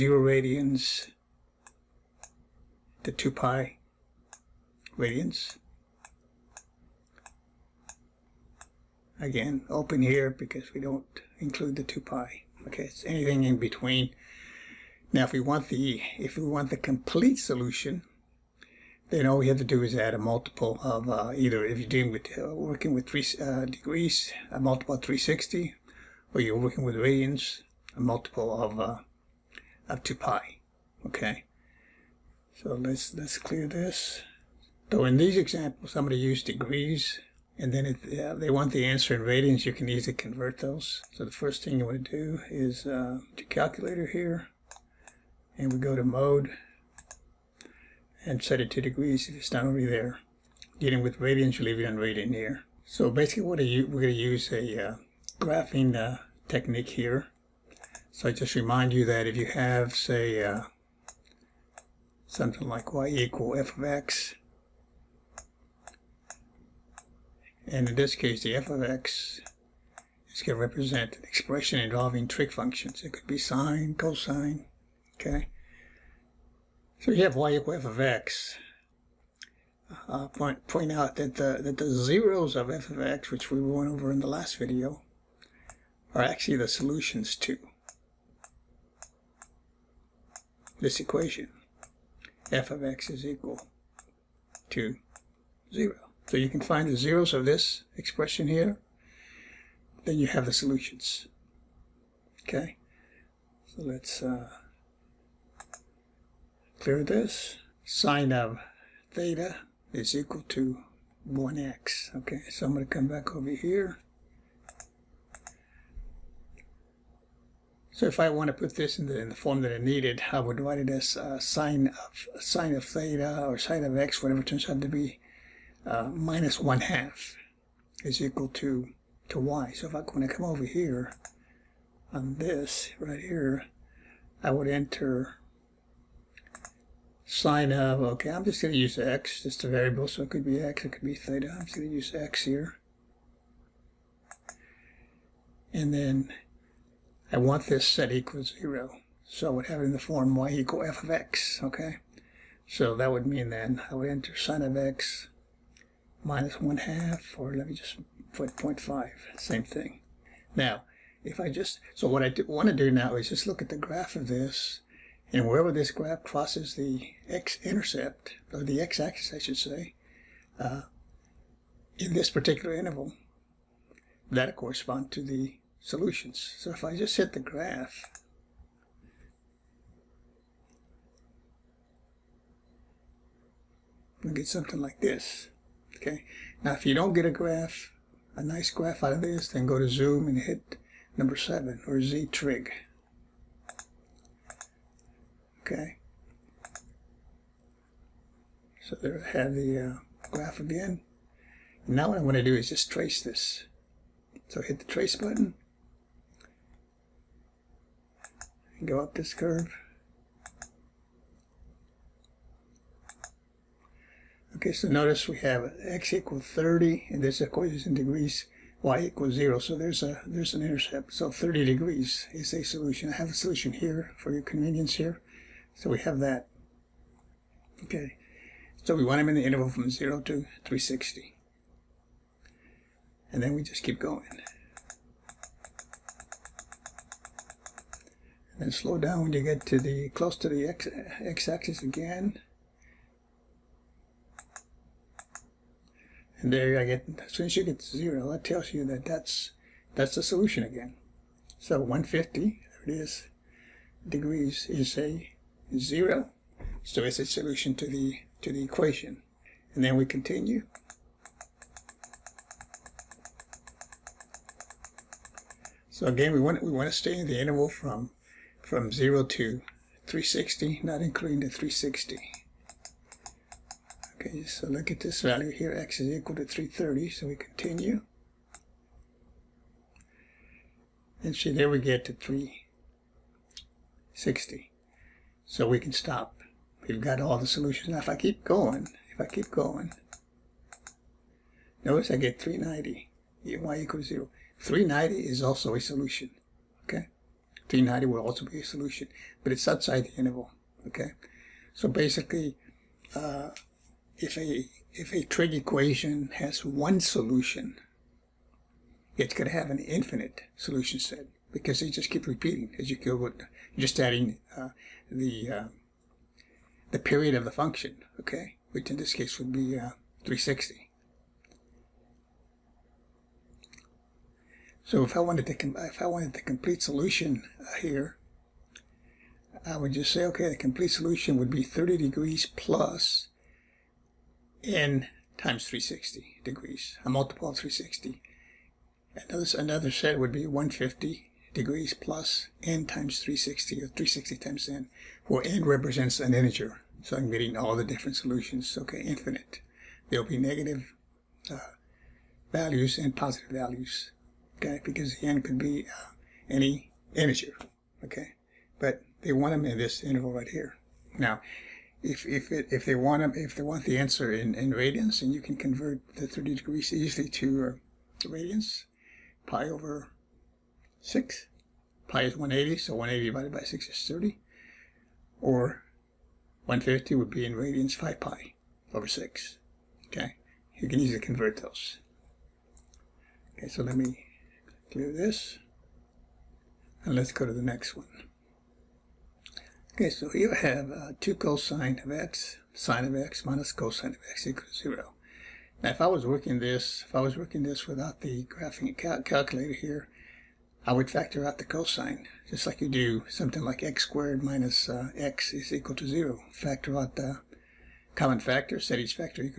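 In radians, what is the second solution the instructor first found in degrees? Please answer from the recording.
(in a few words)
5 pi over 6.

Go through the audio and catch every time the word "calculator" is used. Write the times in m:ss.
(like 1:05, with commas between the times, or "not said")
0:43, 6:39.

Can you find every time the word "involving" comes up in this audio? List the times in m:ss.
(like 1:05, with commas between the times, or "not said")
1:11.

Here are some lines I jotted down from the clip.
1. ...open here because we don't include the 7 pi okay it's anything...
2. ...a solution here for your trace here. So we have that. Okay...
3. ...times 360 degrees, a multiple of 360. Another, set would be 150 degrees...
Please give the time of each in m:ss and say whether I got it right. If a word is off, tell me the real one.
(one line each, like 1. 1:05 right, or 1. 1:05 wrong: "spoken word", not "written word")
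1. 0:09 wrong: "2", not "7"
2. 3:43 wrong: "convenience", not "trace"
3. 5:35 right.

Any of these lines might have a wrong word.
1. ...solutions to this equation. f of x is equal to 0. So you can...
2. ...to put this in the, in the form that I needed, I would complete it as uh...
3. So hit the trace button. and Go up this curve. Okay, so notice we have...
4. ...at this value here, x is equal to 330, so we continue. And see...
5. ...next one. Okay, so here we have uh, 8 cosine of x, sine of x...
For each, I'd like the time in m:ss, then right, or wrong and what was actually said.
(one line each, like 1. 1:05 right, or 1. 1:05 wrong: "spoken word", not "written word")
1. 1:26 right
2. 1:58 wrong: "write", not "complete"
3. 3:24 right
4. 4:34 right
5. 6:27 wrong: "2", not "8".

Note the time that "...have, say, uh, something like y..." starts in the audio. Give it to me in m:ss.
0:59.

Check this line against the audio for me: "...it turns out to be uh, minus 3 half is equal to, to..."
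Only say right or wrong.
wrong.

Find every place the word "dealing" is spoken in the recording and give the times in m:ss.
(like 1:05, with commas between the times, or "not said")
0:21, 0:50.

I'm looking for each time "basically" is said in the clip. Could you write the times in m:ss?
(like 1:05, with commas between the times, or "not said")
0:53, 5:01.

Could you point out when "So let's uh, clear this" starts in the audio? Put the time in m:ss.
1:43.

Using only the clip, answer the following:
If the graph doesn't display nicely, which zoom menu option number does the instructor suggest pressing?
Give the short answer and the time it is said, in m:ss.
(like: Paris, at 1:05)
7, at 3:11.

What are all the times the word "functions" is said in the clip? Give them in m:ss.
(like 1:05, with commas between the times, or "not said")
1:12, 5:17.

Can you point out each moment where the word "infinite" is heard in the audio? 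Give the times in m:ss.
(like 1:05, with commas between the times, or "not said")
5:09, 5:49.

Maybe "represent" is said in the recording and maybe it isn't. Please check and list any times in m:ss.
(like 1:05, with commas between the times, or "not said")
1:10, 5:45.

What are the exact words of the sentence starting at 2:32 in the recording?
So that would mean then I would enter sine of x minus 1 half, or let me just put 0.5, same thing.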